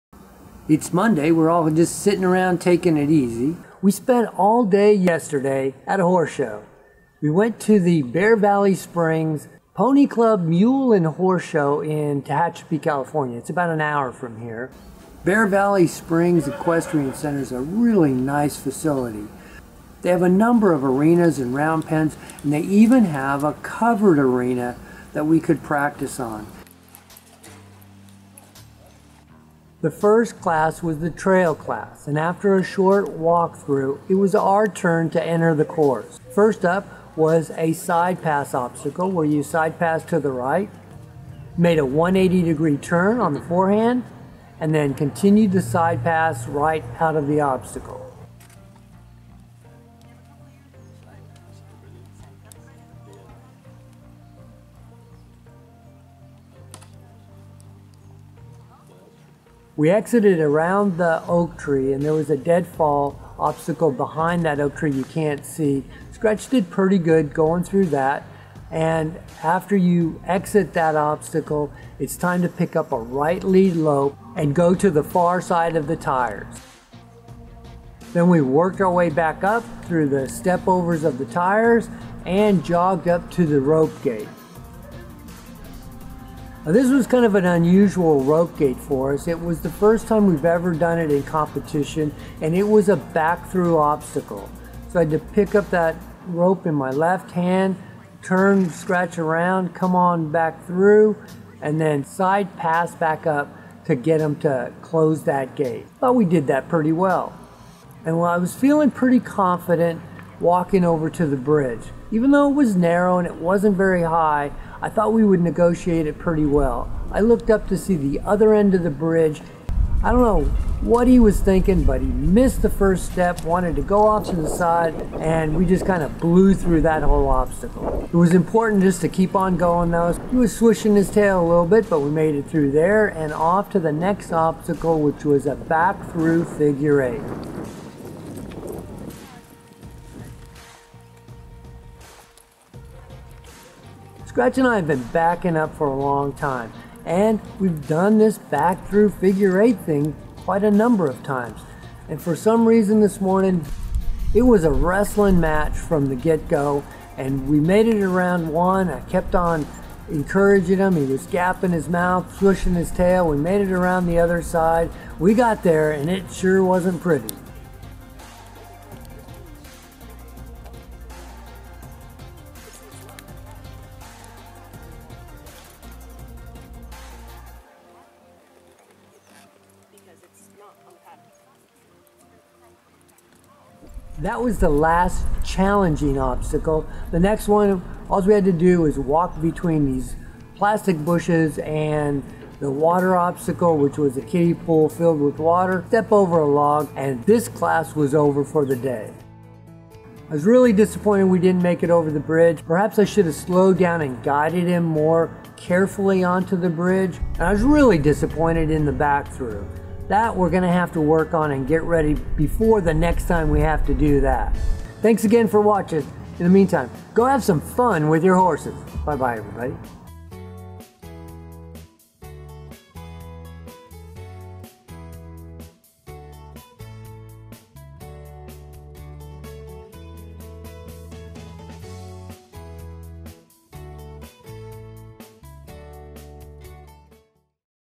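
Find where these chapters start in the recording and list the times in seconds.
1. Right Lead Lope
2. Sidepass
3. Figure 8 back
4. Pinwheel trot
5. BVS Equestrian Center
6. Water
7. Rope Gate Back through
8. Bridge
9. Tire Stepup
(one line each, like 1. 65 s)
1. 66 s
2. 35 s
3. 141 s
4. 127 s
5. 16 s
6. 186 s
7. 88 s
8. 116 s
9. 77 s.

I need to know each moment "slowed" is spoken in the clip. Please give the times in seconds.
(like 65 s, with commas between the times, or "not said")
203 s.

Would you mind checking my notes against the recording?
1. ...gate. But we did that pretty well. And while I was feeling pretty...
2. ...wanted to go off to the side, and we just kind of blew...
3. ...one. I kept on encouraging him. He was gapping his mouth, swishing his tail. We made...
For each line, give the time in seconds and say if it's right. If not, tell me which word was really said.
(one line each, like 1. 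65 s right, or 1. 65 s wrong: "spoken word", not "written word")
1. 105 s right
2. 123 s right
3. 158 s right.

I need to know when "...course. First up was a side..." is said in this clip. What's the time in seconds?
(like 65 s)
35 s.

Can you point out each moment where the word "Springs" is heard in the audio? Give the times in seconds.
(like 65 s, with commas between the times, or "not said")
8 s, 15 s.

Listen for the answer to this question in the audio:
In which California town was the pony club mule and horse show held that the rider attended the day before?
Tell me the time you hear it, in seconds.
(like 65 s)
12 s.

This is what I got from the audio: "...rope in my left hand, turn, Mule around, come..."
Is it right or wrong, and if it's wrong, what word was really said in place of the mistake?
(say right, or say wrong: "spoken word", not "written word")
wrong: "Scratch", not "Mule".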